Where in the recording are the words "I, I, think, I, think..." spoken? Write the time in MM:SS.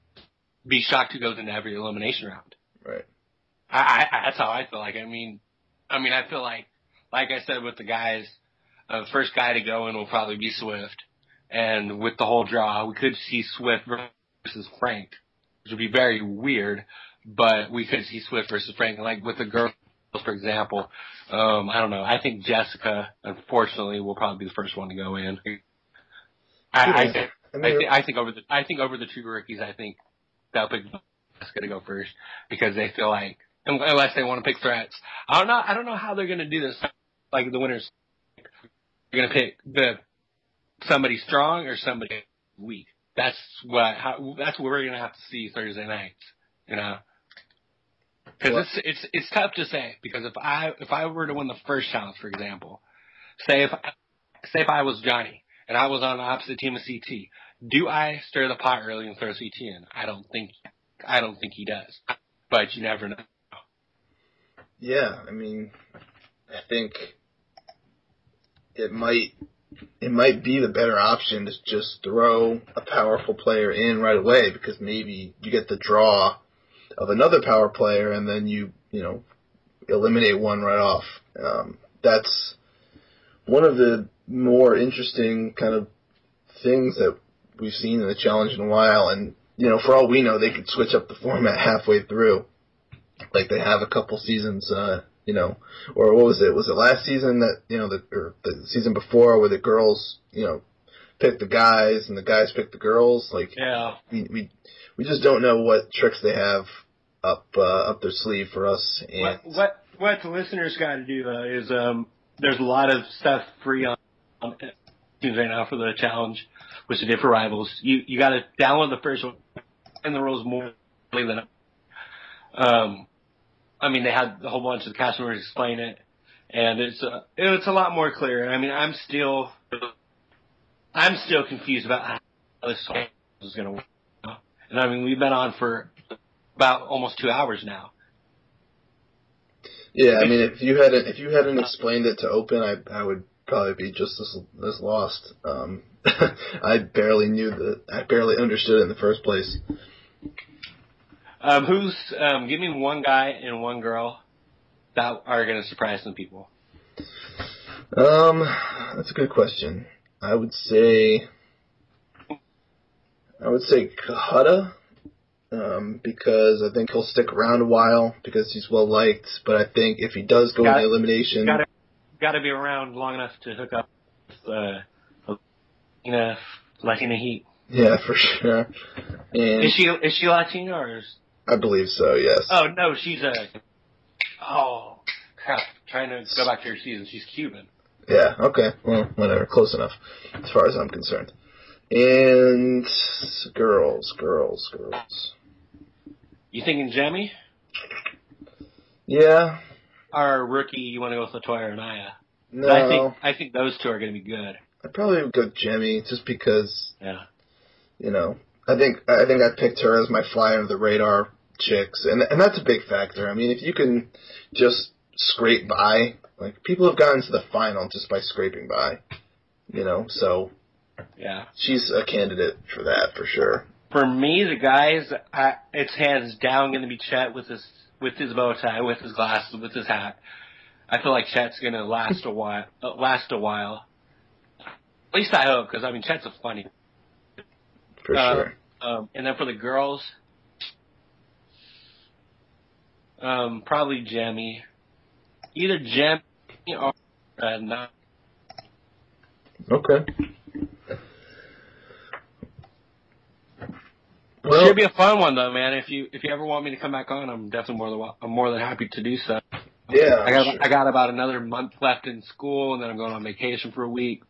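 00:26.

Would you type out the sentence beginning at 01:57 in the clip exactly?
You you got to download the first one and the rules more than.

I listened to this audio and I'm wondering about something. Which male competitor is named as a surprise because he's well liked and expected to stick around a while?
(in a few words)
Cohutta.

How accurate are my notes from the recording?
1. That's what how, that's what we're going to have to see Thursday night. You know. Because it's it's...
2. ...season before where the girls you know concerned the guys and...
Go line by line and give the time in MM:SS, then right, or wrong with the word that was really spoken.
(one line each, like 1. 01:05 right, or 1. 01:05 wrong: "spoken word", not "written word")
1. 00:43 right
2. 01:38 wrong: "picked", not "concerned".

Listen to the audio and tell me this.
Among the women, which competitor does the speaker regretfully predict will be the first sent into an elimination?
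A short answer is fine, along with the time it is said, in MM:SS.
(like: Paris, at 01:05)
Jessica, at 00:22.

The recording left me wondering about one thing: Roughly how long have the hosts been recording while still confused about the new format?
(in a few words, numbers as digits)
almost 2 hours.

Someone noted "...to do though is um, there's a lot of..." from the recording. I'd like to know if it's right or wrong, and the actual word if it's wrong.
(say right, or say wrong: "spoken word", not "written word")
right.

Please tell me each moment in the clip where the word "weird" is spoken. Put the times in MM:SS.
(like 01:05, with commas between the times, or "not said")
00:16.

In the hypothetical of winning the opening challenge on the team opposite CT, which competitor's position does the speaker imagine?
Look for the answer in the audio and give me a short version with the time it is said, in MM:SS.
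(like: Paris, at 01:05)
Johnny, at 00:55.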